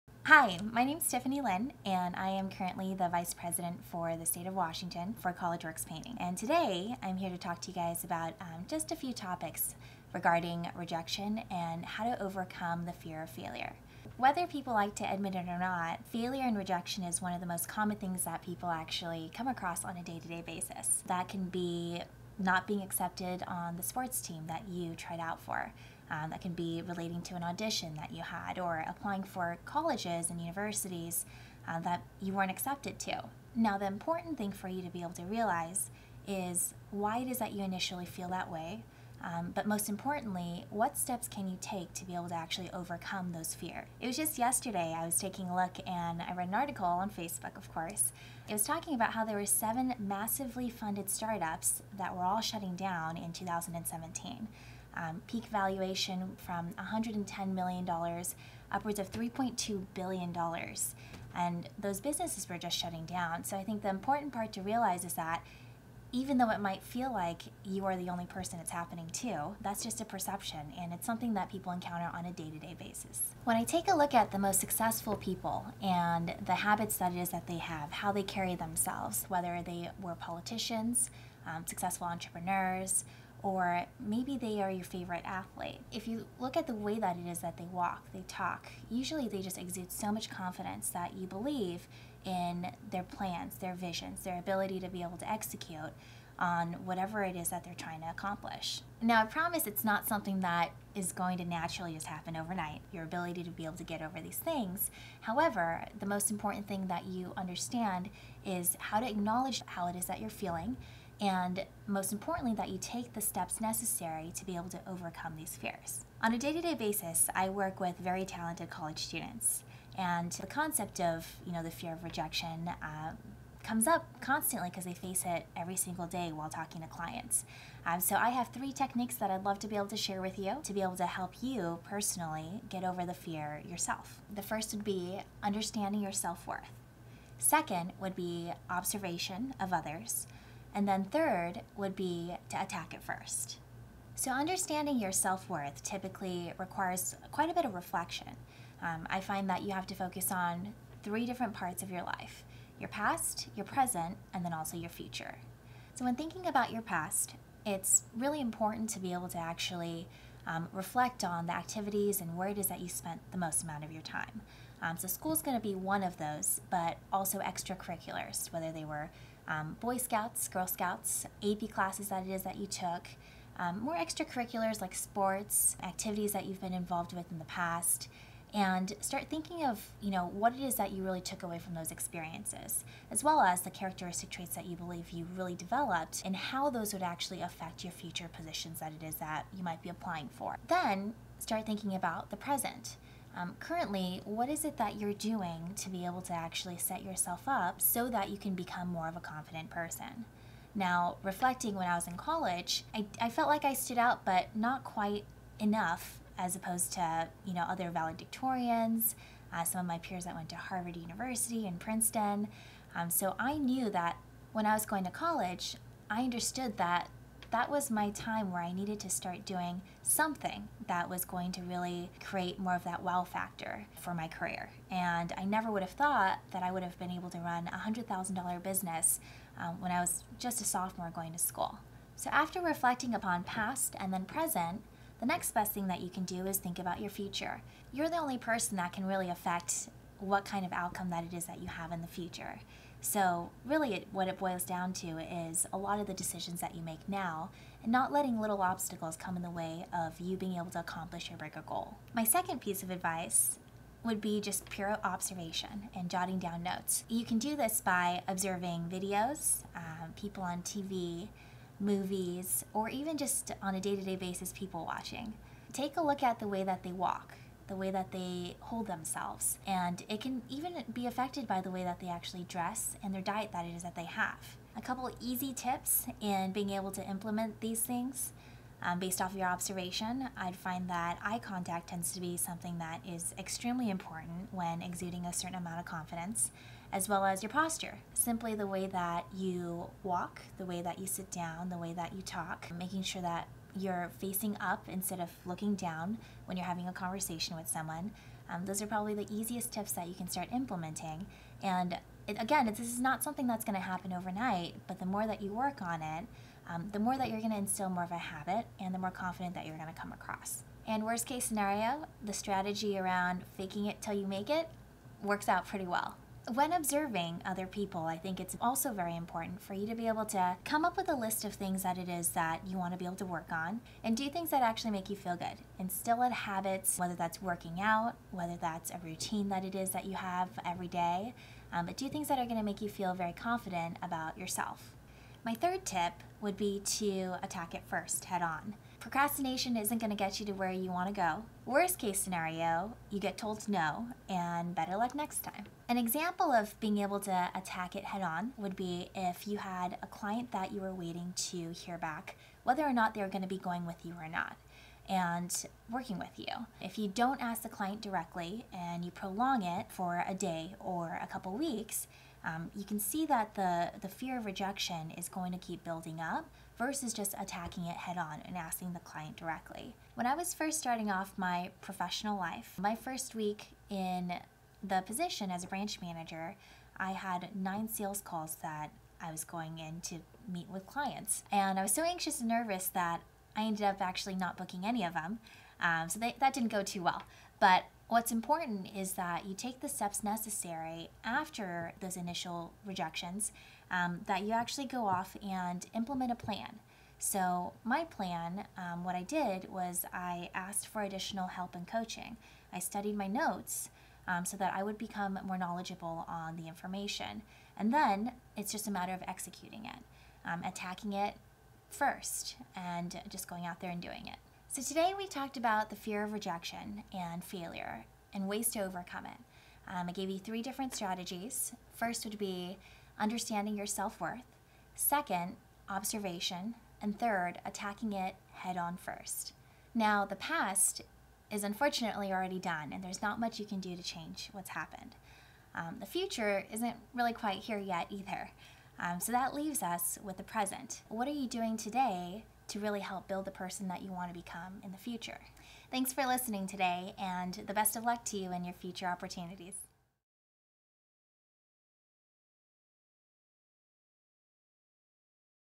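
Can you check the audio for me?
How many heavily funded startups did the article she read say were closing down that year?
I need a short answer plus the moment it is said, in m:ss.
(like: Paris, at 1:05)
7, at 0:49.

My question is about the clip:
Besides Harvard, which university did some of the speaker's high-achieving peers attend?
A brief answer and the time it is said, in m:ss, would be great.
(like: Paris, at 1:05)
Princeton, at 3:31.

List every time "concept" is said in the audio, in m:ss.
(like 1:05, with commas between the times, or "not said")
2:00.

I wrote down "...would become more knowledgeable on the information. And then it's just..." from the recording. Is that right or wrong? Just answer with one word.
right.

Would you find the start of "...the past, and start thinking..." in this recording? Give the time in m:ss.
2:57.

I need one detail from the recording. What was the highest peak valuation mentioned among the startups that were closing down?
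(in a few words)
$3.2 billion.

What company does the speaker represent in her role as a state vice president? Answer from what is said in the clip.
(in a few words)
College Works Painting.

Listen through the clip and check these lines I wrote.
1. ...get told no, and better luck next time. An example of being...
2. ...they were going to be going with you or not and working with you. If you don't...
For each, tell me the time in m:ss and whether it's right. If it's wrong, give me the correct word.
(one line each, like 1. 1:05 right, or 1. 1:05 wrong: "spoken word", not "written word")
1. 5:43 right
2. 5:53 right.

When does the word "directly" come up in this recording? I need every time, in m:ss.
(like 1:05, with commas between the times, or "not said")
5:58, 6:09.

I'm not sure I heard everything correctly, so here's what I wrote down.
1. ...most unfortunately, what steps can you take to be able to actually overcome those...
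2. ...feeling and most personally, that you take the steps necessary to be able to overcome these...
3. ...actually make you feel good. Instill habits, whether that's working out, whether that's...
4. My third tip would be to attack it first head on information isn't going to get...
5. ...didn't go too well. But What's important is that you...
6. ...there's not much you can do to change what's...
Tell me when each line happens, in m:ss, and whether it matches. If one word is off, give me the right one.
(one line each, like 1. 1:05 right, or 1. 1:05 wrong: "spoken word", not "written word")
1. 0:39 wrong: "importantly", not "unfortunately"
2. 1:50 wrong: "importantly", not "personally"
3. 5:24 right
4. 5:35 wrong: "procrastination", not "information"
5. 6:26 right
6. 7:13 right.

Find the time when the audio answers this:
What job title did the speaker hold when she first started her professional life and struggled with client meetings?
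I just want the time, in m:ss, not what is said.
6:15.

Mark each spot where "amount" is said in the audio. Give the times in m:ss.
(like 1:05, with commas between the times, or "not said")
2:43, 4:45.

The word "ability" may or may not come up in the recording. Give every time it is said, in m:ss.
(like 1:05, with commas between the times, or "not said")
1:34, 1:43.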